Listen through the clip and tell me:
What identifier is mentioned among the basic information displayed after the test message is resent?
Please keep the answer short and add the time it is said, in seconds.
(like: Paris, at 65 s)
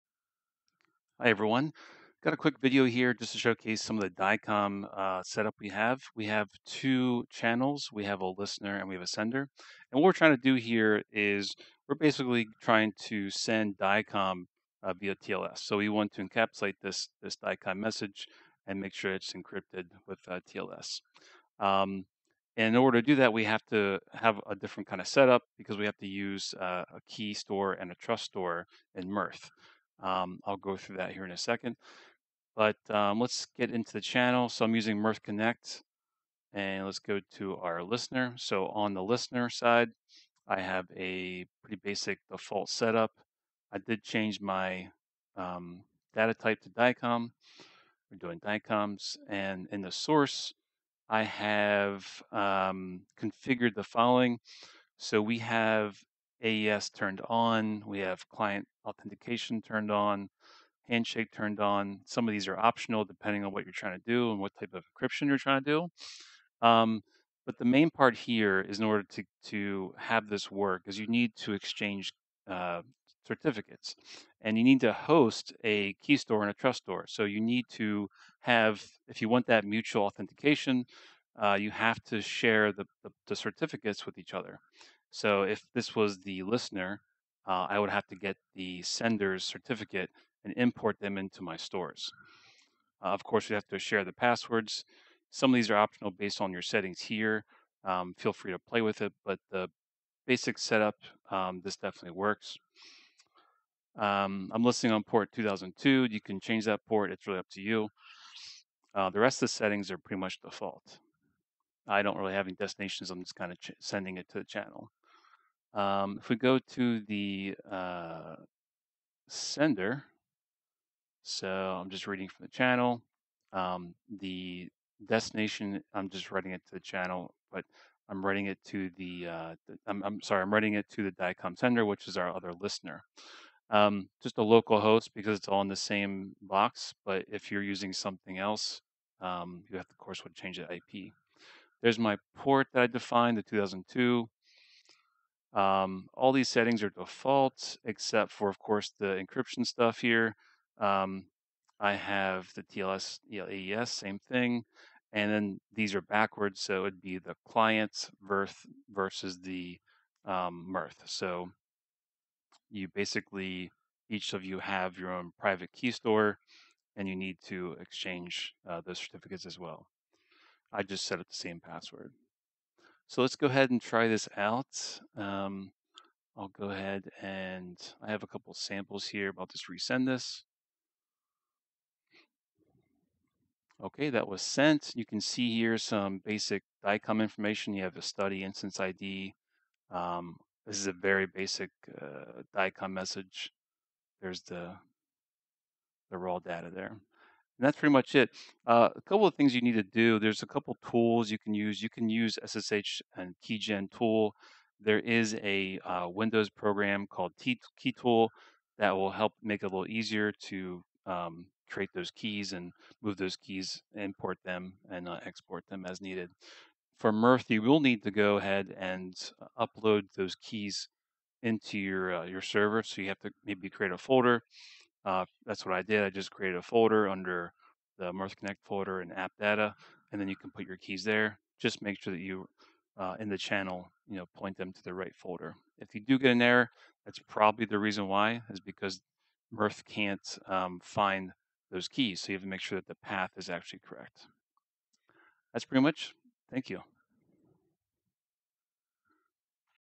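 study instance ID, at 188 s.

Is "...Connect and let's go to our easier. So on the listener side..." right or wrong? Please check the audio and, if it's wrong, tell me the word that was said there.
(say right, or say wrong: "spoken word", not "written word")
wrong: "listener", not "easier".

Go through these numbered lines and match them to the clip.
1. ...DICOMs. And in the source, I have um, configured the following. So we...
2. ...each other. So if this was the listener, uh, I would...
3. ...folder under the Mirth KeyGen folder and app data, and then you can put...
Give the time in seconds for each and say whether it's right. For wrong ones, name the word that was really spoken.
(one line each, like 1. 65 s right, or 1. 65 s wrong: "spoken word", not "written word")
1. 48 s right
2. 84 s right
3. 226 s wrong: "Connect", not "KeyGen".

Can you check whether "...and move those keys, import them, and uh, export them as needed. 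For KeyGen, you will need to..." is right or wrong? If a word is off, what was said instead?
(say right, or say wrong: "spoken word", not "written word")
wrong: "Murphy", not "KeyGen".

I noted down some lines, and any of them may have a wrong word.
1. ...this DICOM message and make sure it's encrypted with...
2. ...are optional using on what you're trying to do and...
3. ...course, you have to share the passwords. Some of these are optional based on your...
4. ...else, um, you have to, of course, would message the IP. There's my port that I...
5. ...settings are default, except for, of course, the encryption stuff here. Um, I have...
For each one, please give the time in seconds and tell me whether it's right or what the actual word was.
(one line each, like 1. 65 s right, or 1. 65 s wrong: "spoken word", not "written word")
1. 17 s right
2. 62 s wrong: "depending", not "using"
3. 93 s right
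4. 138 s wrong: "change", not "message"
5. 146 s right.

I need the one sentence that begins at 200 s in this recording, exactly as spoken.
There's a couple tools you can use.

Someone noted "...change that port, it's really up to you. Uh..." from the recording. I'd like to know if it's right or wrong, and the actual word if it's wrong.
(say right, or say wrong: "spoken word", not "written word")
right.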